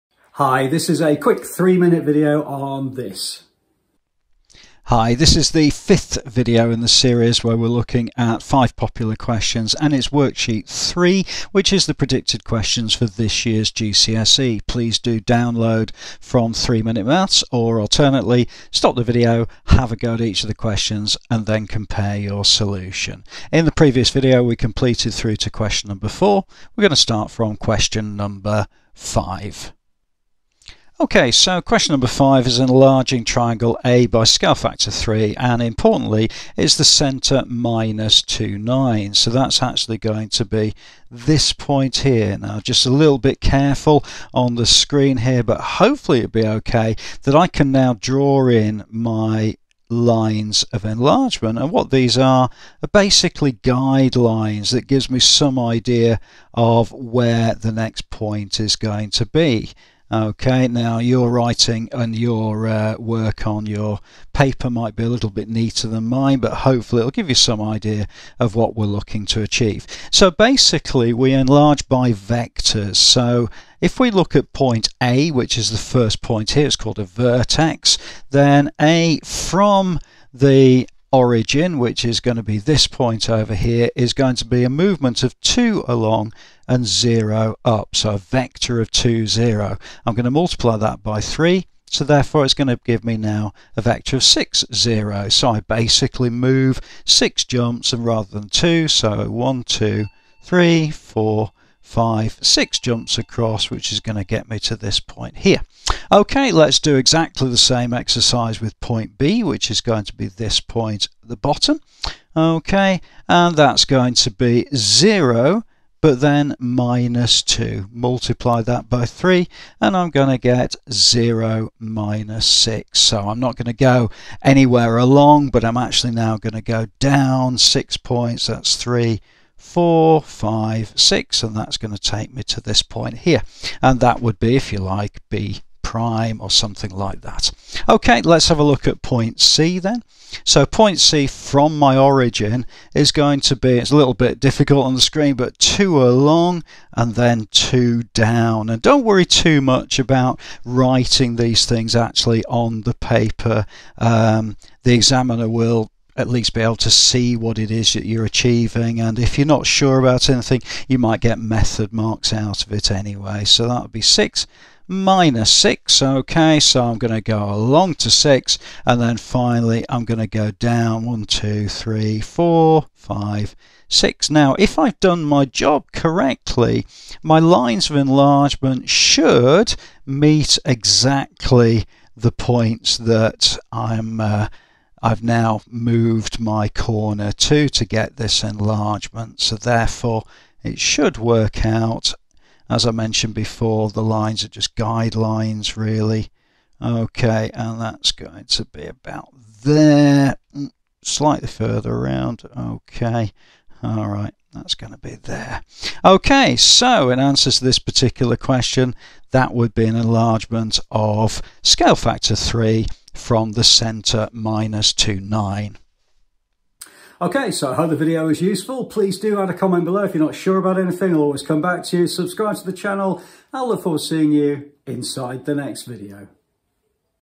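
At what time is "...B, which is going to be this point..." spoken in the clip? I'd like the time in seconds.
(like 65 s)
109 s.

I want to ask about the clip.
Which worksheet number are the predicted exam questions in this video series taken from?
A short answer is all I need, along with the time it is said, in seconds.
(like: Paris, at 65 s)
3, at 10 s.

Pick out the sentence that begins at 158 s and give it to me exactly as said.
And if you're not sure about anything, you might get method marks out of it anyway.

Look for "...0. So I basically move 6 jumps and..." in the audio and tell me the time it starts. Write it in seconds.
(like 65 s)
94 s.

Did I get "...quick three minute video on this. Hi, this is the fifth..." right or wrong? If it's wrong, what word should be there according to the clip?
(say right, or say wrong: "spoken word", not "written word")
right.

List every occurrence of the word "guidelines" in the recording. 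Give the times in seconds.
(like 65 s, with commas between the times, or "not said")
53 s, 194 s.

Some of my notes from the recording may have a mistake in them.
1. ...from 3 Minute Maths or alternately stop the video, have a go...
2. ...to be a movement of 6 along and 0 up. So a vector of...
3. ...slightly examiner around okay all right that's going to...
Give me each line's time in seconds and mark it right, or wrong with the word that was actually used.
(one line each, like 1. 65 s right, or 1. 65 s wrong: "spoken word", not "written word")
1. 16 s right
2. 84 s wrong: "2", not "6"
3. 201 s wrong: "further", not "examiner".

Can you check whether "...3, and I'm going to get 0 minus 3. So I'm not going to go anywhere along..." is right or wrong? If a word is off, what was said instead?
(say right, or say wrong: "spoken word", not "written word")
wrong: "6", not "3".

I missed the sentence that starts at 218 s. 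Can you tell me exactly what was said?
Please do add a comment below if you're not sure about anything.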